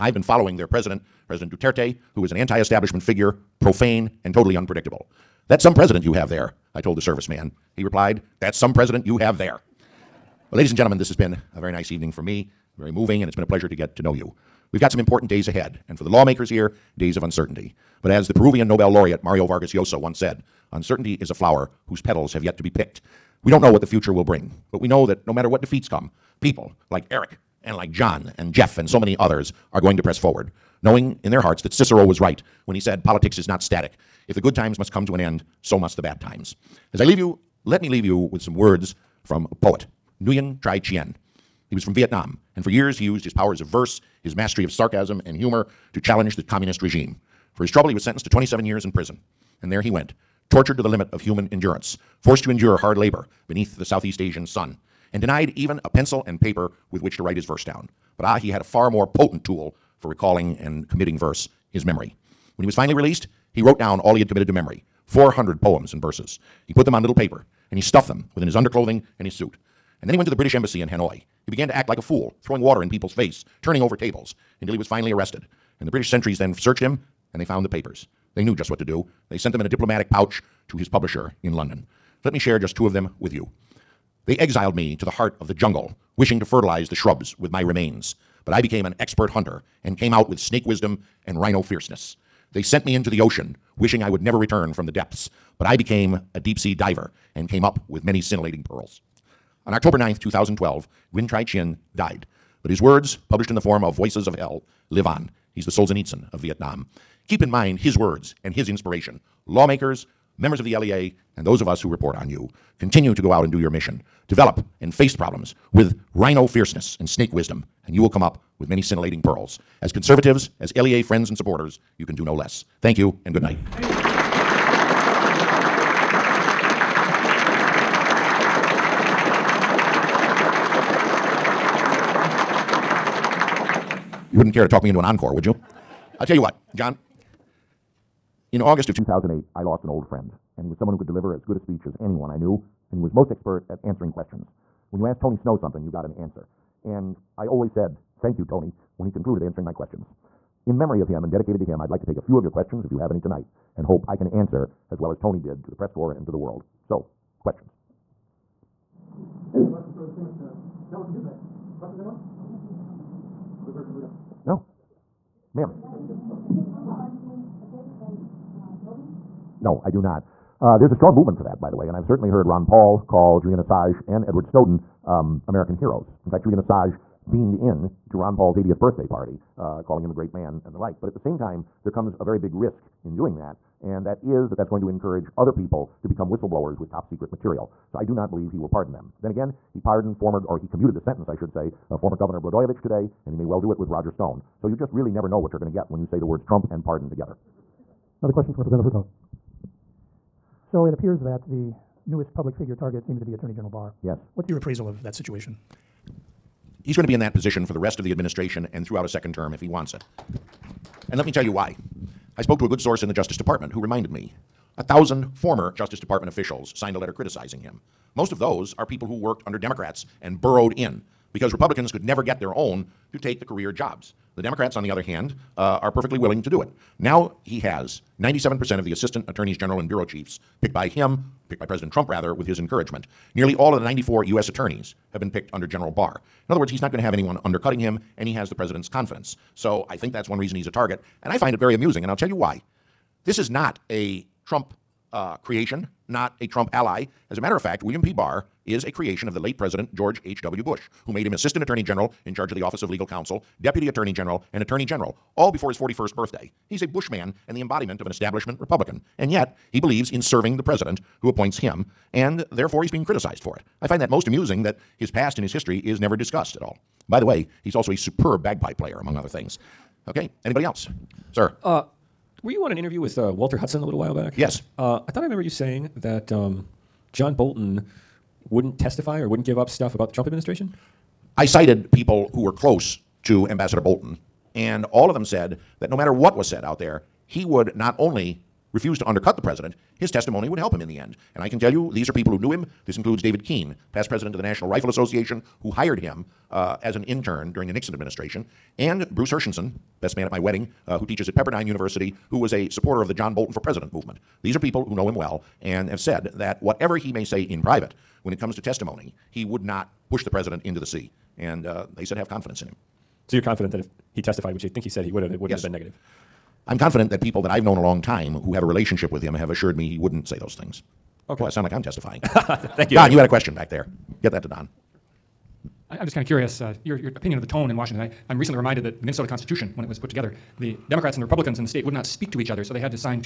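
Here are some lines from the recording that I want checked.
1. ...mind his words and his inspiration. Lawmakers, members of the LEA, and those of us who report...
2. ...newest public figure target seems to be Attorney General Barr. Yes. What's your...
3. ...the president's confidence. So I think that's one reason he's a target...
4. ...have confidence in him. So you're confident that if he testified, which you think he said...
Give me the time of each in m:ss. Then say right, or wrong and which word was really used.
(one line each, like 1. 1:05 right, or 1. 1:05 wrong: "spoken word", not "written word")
1. 1:47 right
2. 3:22 right
3. 3:58 right
4. 5:12 right.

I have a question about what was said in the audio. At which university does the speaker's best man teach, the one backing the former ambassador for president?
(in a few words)
Pepperdine University.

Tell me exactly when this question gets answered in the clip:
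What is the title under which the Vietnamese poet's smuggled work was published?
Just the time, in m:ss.
1:43.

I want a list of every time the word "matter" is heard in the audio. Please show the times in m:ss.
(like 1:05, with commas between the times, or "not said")
0:25, 4:07, 4:45.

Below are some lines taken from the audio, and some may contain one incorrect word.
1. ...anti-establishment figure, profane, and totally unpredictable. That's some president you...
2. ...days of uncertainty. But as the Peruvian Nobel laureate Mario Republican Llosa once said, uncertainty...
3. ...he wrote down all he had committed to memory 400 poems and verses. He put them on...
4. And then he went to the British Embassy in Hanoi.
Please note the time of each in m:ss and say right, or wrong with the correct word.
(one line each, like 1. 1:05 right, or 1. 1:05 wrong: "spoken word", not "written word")
1. 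0:02 right
2. 0:16 wrong: "Vargas", not "Republican"
3. 1:03 right
4. 1:10 right.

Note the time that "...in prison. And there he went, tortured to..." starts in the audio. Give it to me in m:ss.
0:48.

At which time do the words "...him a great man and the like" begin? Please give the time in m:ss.
3:00.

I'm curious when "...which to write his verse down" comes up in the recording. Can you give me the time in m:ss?
0:57.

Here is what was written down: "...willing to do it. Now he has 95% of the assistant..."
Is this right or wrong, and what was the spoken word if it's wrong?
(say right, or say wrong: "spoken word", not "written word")
wrong: "97", not "95".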